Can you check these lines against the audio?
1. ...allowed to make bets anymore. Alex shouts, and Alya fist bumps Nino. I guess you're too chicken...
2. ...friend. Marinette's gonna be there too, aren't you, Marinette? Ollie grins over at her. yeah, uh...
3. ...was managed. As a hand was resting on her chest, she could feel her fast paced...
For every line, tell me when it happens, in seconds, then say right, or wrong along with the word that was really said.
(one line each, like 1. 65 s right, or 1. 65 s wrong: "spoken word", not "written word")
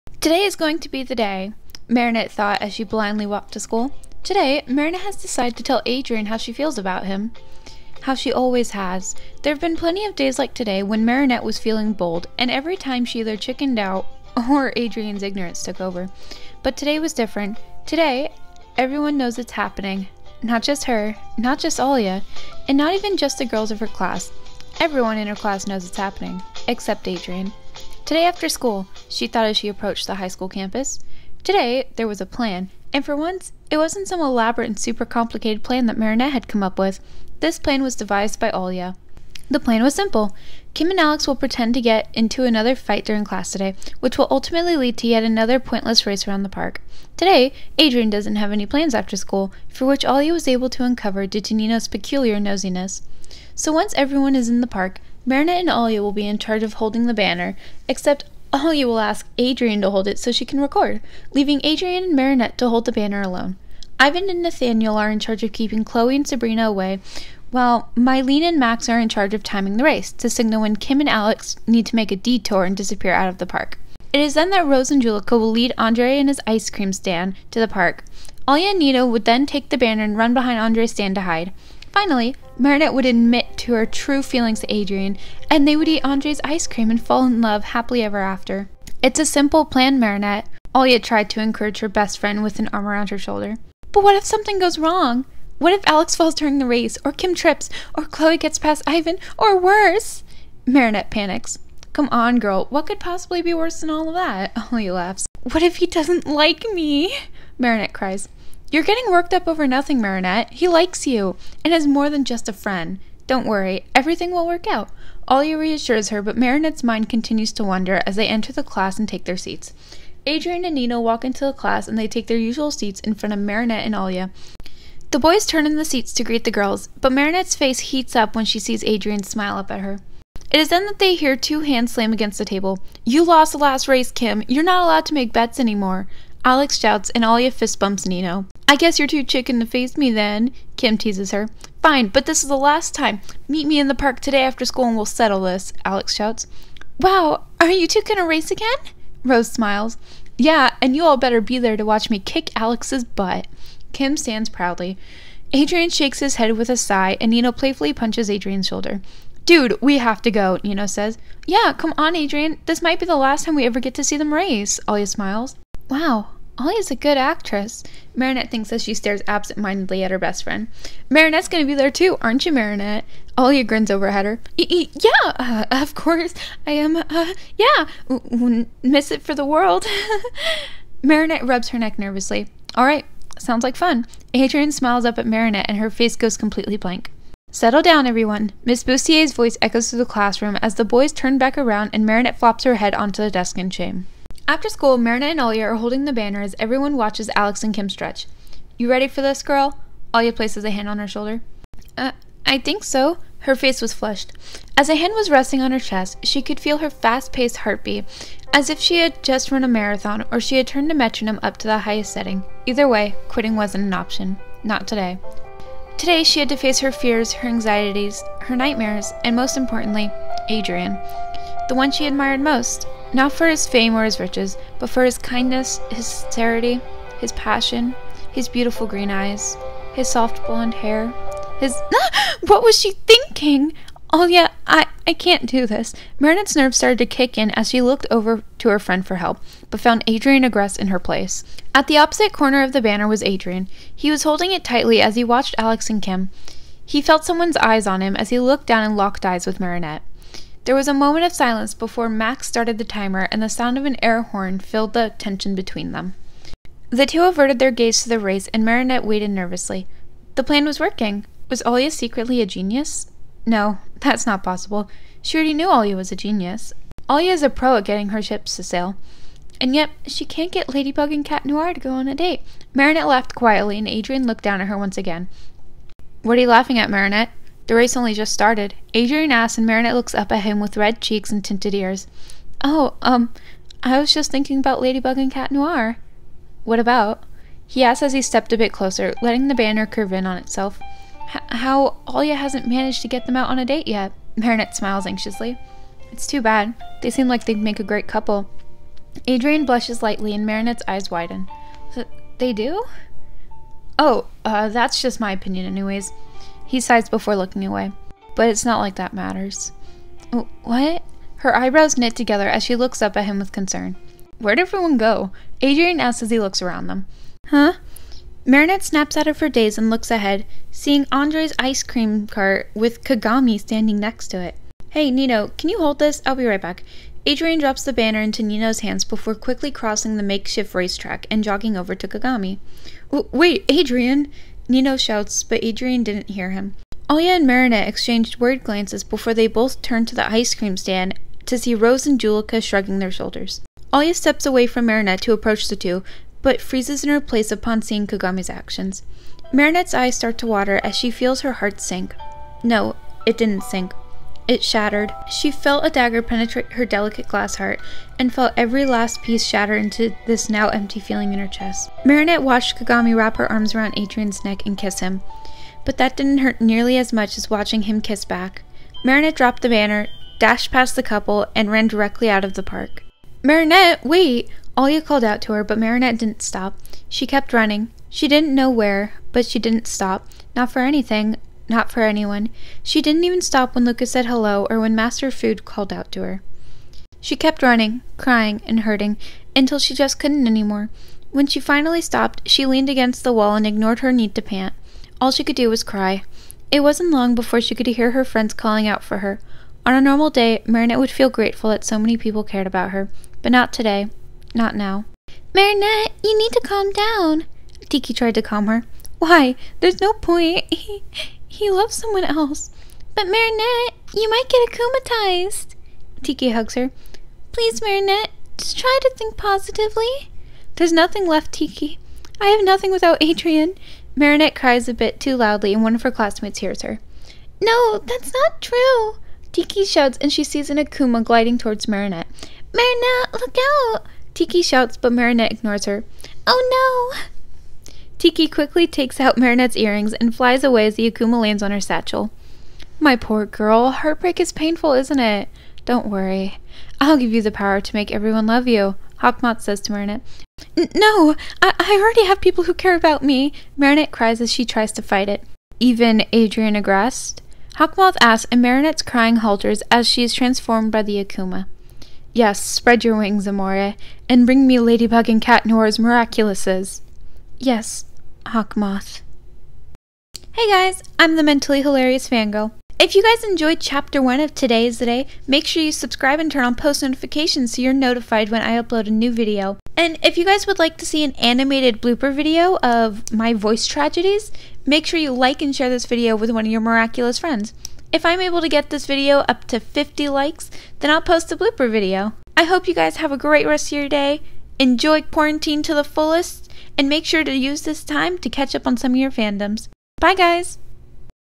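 1. 134 s right
2. 170 s right
3. 203 s wrong: "flushed", not "managed".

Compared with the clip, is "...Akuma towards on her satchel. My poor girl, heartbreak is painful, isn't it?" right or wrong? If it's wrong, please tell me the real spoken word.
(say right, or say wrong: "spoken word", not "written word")
wrong: "lands", not "towards".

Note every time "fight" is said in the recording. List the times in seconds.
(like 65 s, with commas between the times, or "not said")
42 s, 455 s.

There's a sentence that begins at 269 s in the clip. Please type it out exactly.
And yet, she can't get Ladybug and Cat Noir to go on a date.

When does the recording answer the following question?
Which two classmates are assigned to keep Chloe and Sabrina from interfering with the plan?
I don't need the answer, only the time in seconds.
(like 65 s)
63 s.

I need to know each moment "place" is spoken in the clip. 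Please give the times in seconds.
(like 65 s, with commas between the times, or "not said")
200 s, 240 s, 347 s.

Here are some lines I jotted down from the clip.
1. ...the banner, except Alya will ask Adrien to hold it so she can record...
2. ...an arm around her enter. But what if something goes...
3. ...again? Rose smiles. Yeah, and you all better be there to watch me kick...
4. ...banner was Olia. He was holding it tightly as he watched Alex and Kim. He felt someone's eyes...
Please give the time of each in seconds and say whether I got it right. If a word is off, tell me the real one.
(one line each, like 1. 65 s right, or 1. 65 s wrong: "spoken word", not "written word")
1. 57 s right
2. 92 s wrong: "shoulder", not "enter"
3. 148 s right
4. 242 s wrong: "Adrien", not "Olia".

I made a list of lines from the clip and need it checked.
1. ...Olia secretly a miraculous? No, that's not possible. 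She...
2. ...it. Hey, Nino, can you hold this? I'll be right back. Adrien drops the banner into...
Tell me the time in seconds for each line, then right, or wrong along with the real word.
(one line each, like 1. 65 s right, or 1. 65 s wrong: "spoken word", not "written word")
1. 261 s wrong: "genius", not "miraculous"
2. 324 s right.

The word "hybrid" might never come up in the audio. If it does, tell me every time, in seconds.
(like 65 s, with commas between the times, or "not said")
not said.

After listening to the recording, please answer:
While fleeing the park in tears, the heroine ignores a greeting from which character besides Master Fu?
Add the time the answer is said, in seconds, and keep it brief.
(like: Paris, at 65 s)
Luka, at 383 s.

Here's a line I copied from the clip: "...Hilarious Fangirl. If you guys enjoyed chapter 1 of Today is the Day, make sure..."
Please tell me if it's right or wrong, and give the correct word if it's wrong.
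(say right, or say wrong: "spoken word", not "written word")
right.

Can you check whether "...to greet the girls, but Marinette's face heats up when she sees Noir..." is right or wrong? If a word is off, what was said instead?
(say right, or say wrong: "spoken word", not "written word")
wrong: "Adrien", not "Noir".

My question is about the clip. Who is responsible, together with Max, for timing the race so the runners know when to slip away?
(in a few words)
Mylene.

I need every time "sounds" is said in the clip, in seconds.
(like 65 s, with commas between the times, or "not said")
183 s, 253 s.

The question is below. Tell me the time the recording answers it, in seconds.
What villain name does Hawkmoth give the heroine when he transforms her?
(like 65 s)
463 s.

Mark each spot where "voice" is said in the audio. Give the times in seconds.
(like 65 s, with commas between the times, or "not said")
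189 s, 483 s.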